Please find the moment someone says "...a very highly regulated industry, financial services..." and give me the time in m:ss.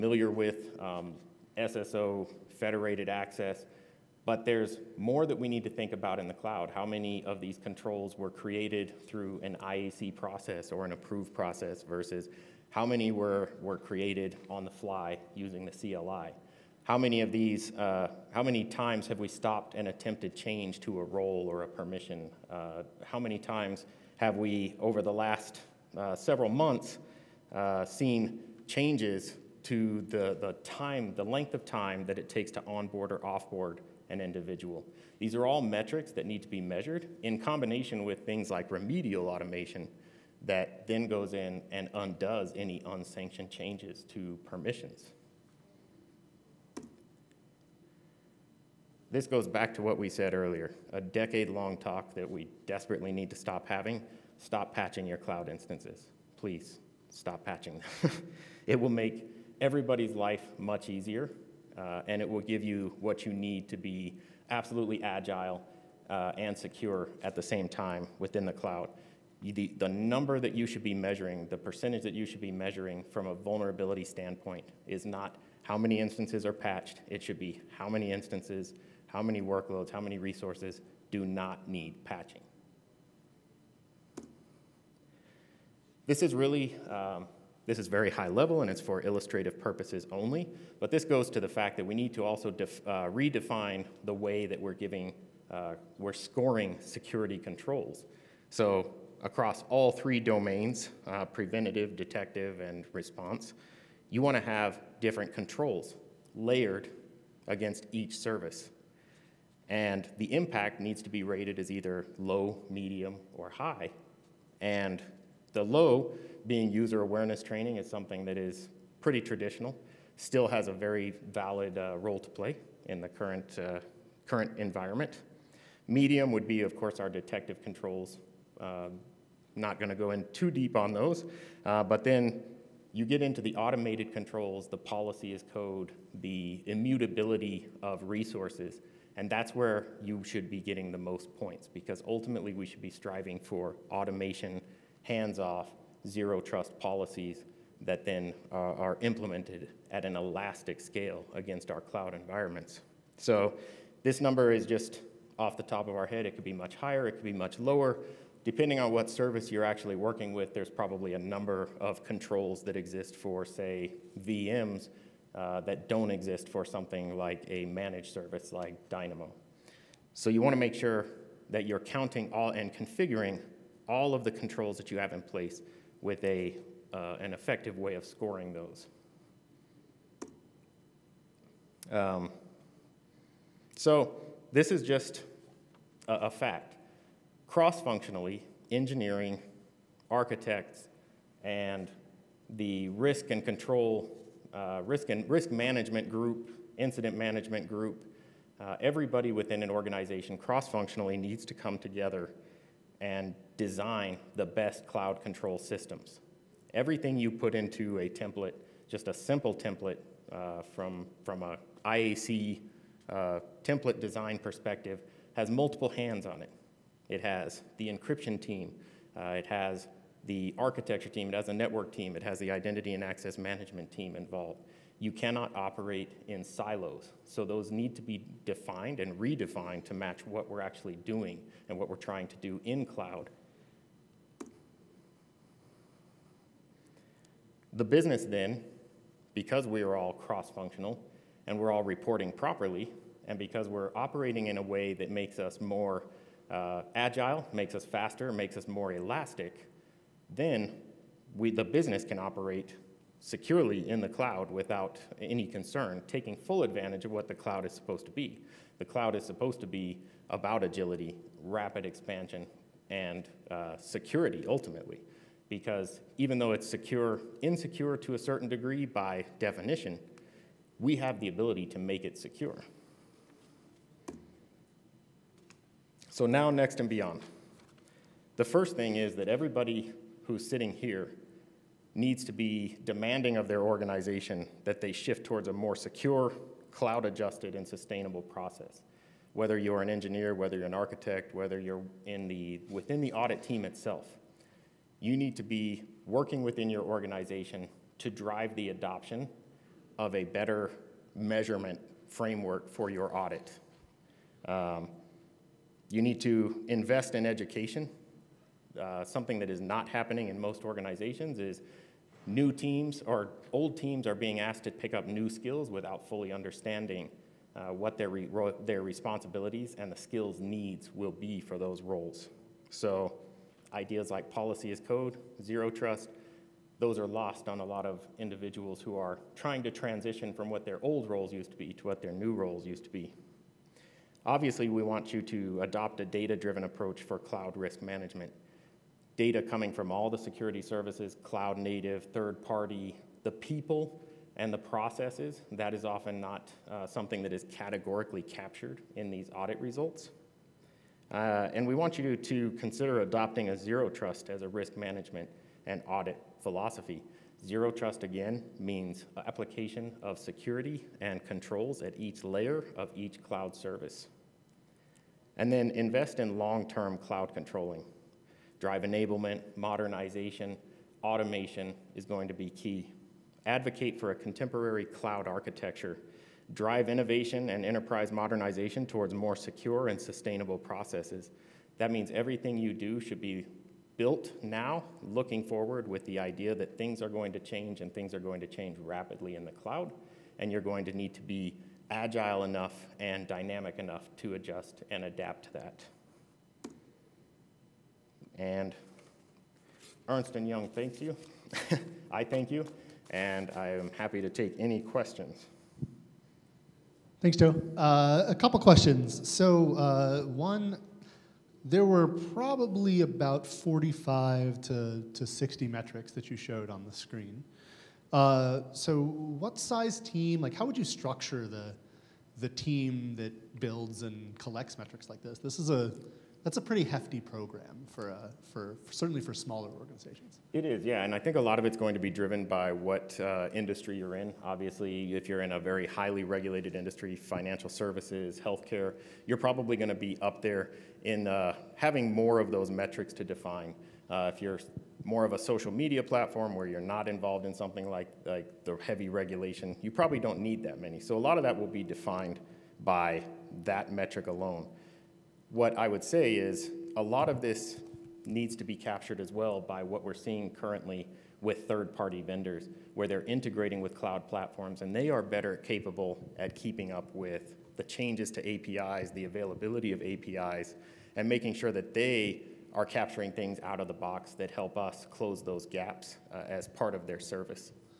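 7:15.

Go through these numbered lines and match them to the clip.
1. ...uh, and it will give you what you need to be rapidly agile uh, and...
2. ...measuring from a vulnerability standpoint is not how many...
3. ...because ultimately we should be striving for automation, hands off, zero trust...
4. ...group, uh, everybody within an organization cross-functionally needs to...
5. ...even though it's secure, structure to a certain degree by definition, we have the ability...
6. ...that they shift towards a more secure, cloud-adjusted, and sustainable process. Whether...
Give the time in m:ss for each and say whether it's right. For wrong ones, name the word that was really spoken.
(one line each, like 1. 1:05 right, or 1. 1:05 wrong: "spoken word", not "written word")
1. 1:01 wrong: "absolutely", not "rapidly"
2. 1:12 right
3. 2:21 right
4. 3:17 right
5. 4:26 wrong: "insecure", not "structure"
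6. 4:44 right.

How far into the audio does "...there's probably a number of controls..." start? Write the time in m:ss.
2:40.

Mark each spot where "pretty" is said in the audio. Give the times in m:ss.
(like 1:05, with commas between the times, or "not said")
1:58, 7:06.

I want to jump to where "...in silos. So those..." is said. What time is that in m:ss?
3:46.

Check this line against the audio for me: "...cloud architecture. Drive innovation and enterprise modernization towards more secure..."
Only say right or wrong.
right.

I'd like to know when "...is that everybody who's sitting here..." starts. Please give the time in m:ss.
4:38.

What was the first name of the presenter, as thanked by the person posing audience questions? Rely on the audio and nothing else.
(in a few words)
Joe.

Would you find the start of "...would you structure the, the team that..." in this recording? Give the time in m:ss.
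7:00.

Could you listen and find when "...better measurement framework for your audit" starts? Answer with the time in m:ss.
5:00.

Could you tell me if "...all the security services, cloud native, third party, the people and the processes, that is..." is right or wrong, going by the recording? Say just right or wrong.
right.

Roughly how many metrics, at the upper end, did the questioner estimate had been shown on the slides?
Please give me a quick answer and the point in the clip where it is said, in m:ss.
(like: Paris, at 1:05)
60, at 6:55.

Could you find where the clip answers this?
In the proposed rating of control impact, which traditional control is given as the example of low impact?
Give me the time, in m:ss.
1:56.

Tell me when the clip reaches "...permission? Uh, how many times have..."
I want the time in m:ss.
0:21.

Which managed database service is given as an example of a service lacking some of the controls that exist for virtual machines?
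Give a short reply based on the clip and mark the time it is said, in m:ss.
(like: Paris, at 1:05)
Dynamo, at 2:48.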